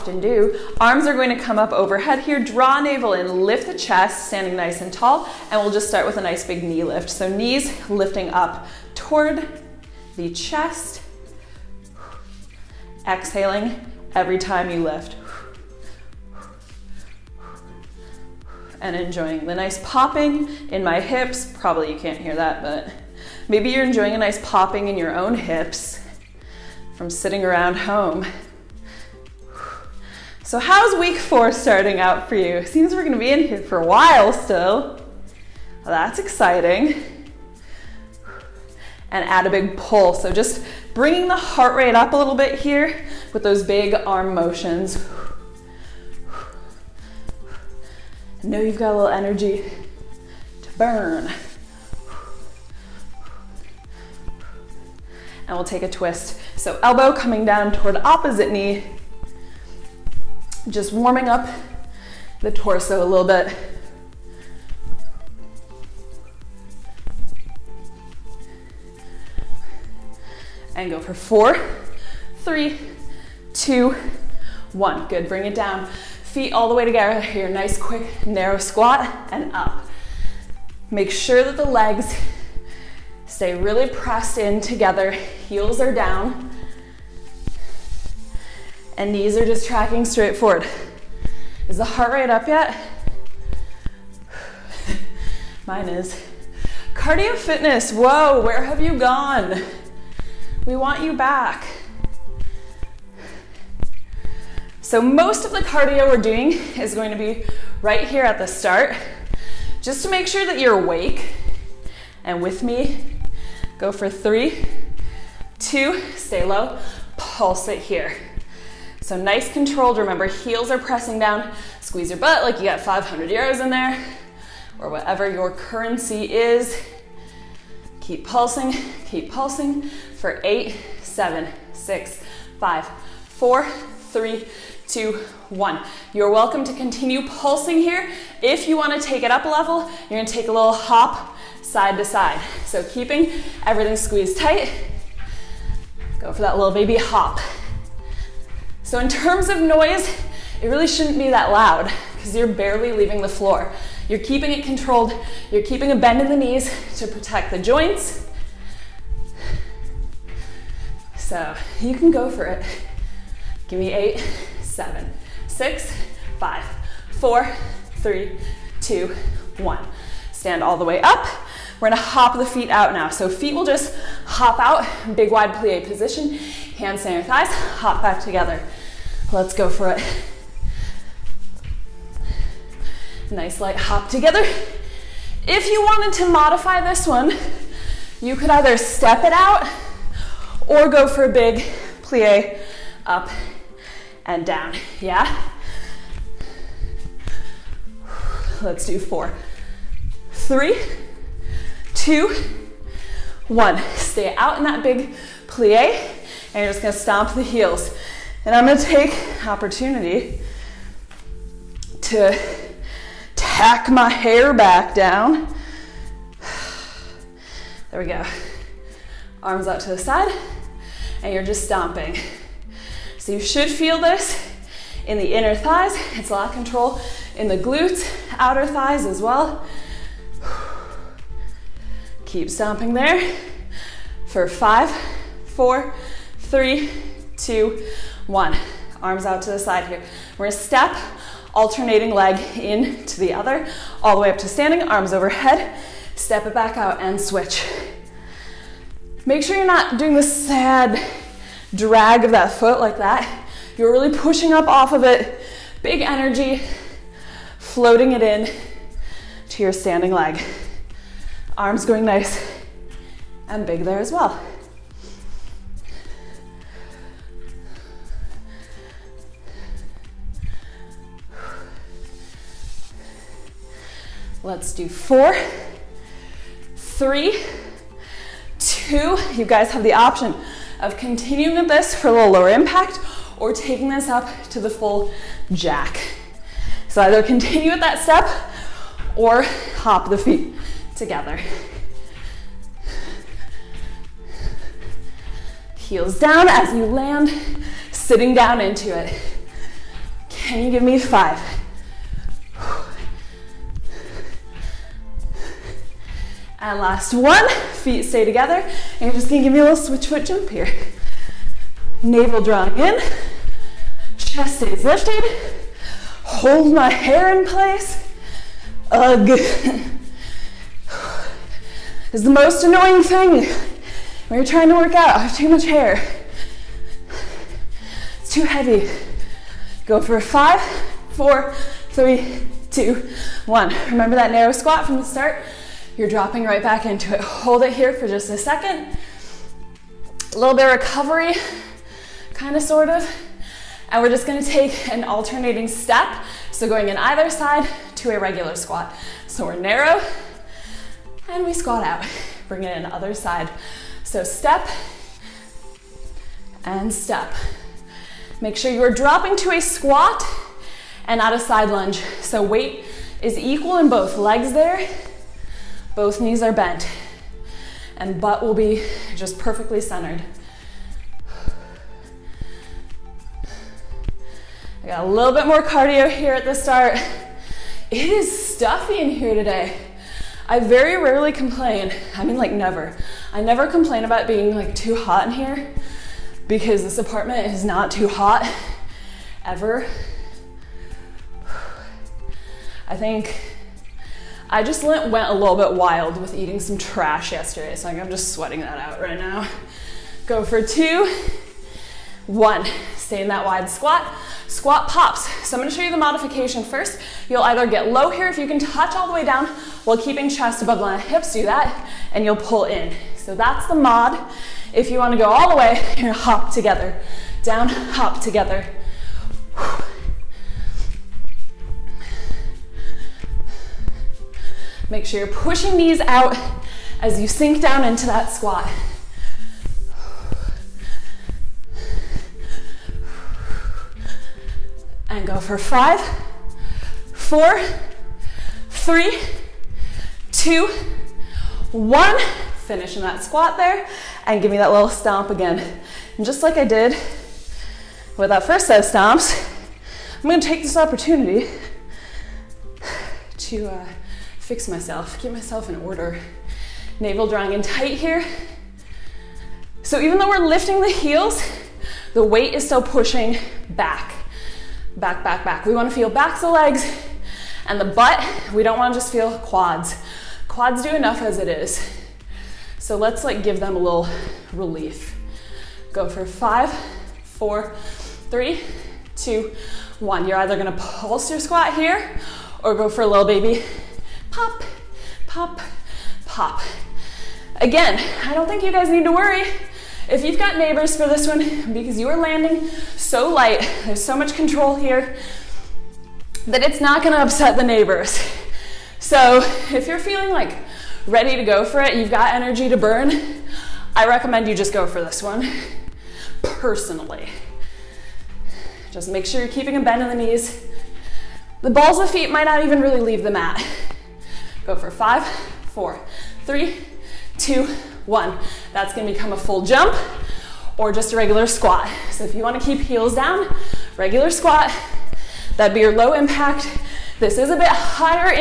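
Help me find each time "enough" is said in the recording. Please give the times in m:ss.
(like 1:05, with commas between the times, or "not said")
7:50.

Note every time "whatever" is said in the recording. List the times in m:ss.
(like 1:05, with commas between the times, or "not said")
2:04.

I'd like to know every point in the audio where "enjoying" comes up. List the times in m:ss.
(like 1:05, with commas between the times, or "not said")
0:18, 0:23.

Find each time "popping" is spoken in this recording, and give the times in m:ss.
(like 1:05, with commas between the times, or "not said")
0:19, 0:24.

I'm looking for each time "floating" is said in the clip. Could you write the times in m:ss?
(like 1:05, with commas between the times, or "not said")
4:17.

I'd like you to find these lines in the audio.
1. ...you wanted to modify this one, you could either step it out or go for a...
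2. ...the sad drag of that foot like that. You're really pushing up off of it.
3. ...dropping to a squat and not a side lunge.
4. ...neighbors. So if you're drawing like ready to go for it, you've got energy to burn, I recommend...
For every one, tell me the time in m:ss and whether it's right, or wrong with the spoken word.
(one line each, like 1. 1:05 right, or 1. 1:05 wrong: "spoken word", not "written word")
1. 3:05 right
2. 4:10 right
3. 5:58 right
4. 8:17 wrong: "feeling", not "drawing".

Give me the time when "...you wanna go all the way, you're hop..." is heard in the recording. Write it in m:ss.
6:54.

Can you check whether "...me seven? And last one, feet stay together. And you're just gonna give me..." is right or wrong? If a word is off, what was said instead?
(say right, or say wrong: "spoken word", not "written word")
wrong: "five", not "seven".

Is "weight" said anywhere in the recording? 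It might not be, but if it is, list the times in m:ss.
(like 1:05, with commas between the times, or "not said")
6:02, 7:42.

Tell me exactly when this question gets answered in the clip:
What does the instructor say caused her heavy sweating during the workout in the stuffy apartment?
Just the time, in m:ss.
6:36.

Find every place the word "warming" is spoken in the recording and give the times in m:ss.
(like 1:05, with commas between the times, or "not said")
1:00.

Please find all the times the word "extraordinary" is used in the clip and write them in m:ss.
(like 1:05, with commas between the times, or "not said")
not said.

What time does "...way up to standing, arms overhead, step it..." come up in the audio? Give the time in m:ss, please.
4:04.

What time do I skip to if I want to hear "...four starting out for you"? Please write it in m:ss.
0:31.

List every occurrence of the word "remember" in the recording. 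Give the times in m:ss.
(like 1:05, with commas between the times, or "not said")
1:59, 5:33.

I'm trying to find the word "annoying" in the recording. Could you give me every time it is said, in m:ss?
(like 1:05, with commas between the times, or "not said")
5:22.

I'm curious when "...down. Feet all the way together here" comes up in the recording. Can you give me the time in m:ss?
1:15.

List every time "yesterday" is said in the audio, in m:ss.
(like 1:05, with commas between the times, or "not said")
6:37.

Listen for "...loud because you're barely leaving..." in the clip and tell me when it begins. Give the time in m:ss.
2:31.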